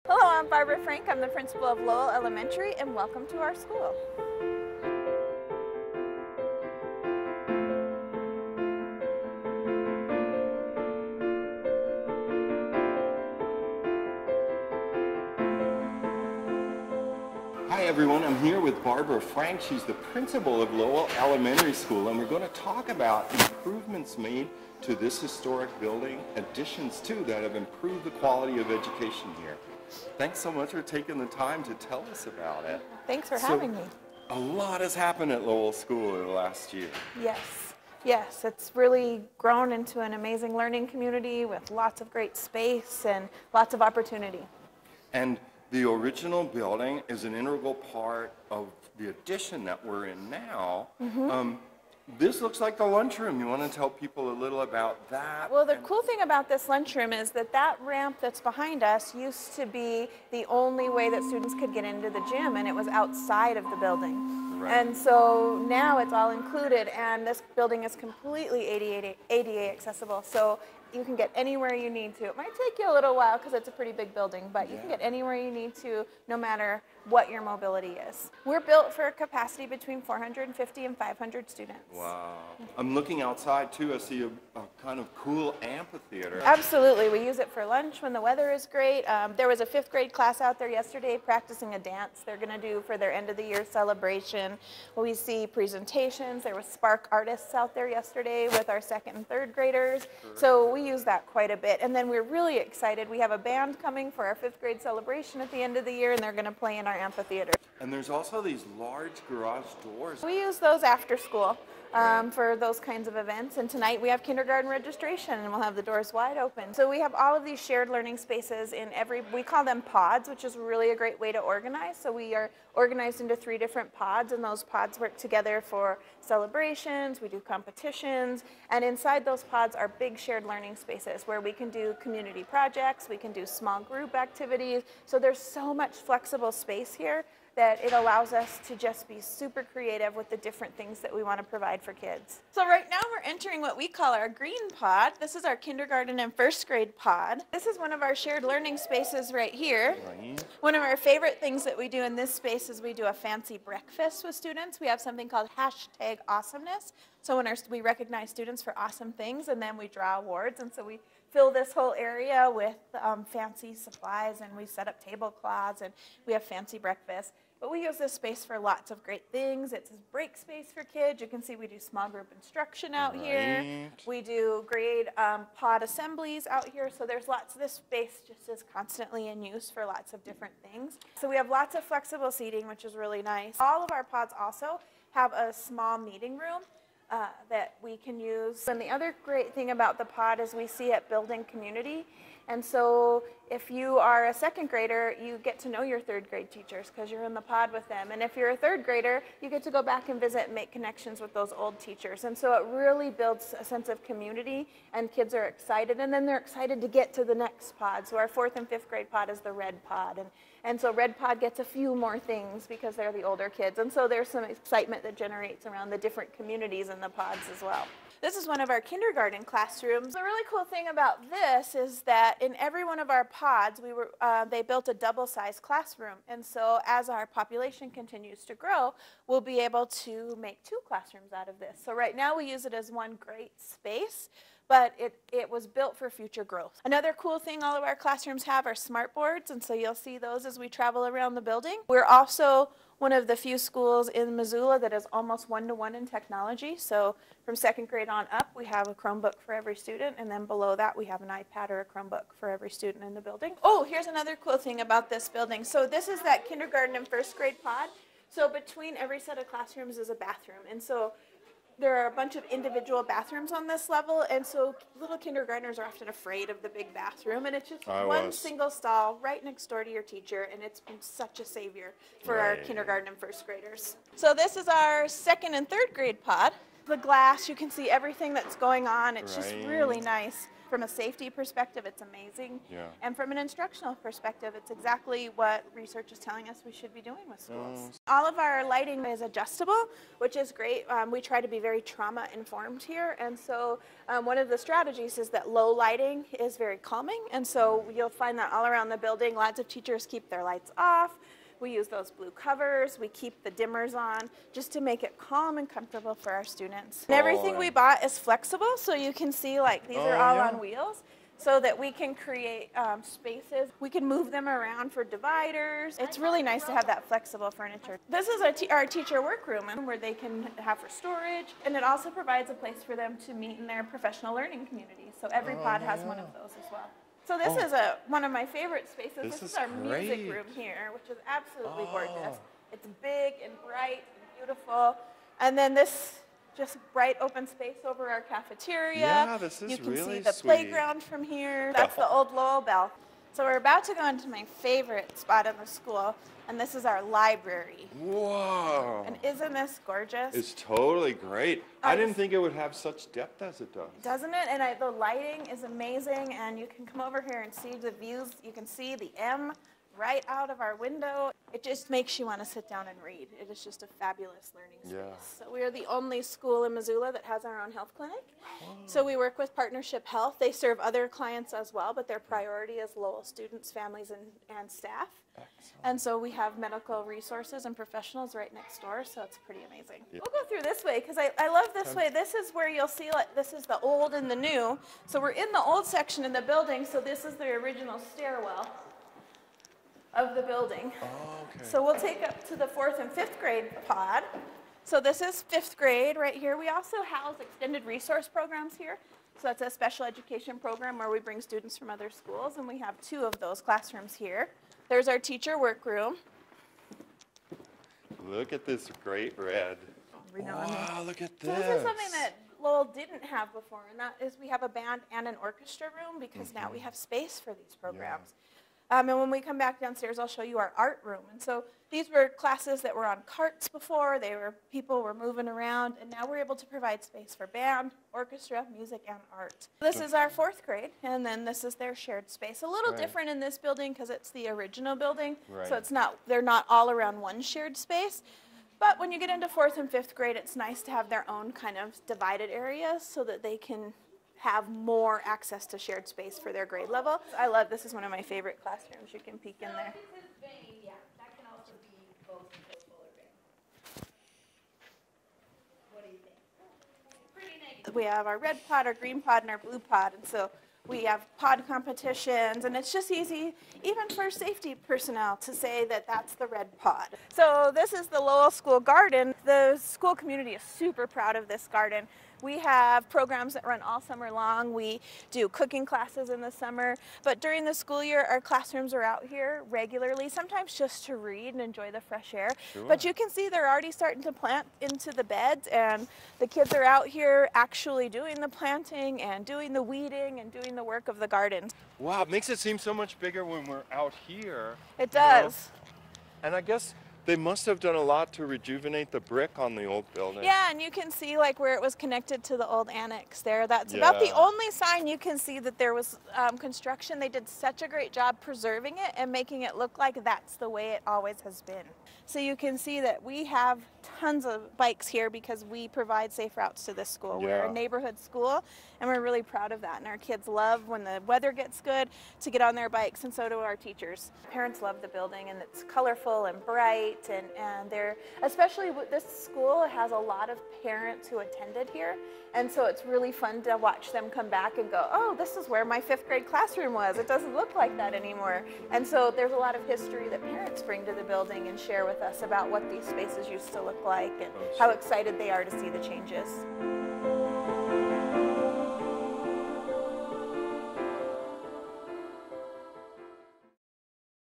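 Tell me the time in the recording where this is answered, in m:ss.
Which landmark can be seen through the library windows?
5:58.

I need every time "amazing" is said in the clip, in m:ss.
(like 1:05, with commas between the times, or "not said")
0:40, 4:42, 5:55, 6:19.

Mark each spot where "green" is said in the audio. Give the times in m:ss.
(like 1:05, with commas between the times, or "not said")
2:24, 7:38.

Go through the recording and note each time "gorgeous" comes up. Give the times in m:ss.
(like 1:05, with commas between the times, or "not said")
5:31, 5:49.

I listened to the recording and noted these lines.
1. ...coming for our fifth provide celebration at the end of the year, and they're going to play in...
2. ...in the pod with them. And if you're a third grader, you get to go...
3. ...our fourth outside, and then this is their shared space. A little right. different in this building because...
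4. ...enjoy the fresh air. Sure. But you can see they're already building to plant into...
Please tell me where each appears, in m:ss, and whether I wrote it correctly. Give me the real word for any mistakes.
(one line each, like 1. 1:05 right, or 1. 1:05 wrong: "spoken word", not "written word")
1. 1:43 wrong: "grade", not "provide"
2. 3:17 right
3. 7:10 wrong: "grade", not "outside"
4. 8:01 wrong: "starting", not "building".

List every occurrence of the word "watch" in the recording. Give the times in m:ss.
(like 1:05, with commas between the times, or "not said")
8:53.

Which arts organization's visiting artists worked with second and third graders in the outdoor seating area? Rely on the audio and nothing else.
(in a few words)
Spark.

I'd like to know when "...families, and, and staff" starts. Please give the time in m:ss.
6:13.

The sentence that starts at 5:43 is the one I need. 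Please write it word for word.
So we're about to go into my favorite spot in the school, and this is our library.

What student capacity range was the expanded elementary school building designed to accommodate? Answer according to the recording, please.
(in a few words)
450 to 500.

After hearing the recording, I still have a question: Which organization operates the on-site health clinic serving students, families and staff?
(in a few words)
Partnership Health.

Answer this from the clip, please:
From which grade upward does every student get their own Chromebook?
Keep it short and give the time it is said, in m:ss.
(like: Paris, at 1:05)
second grade, at 4:07.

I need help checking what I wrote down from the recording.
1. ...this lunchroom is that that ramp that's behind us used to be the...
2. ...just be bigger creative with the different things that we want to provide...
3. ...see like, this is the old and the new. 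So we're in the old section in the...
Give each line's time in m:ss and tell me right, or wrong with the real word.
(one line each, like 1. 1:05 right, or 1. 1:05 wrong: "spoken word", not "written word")
1. 0:56 right
2. 2:18 wrong: "super", not "bigger"
3. 6:22 right.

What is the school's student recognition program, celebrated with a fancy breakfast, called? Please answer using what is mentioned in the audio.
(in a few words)
hashtag awesomeness.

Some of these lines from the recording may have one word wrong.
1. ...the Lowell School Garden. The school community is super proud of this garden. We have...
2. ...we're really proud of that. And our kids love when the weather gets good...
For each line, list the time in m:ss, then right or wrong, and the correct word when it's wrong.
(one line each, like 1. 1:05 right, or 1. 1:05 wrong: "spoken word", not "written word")
1. 7:48 right
2. 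8:39 right.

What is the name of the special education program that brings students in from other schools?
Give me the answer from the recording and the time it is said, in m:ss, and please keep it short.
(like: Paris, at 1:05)
extended resource programs, at 6:37.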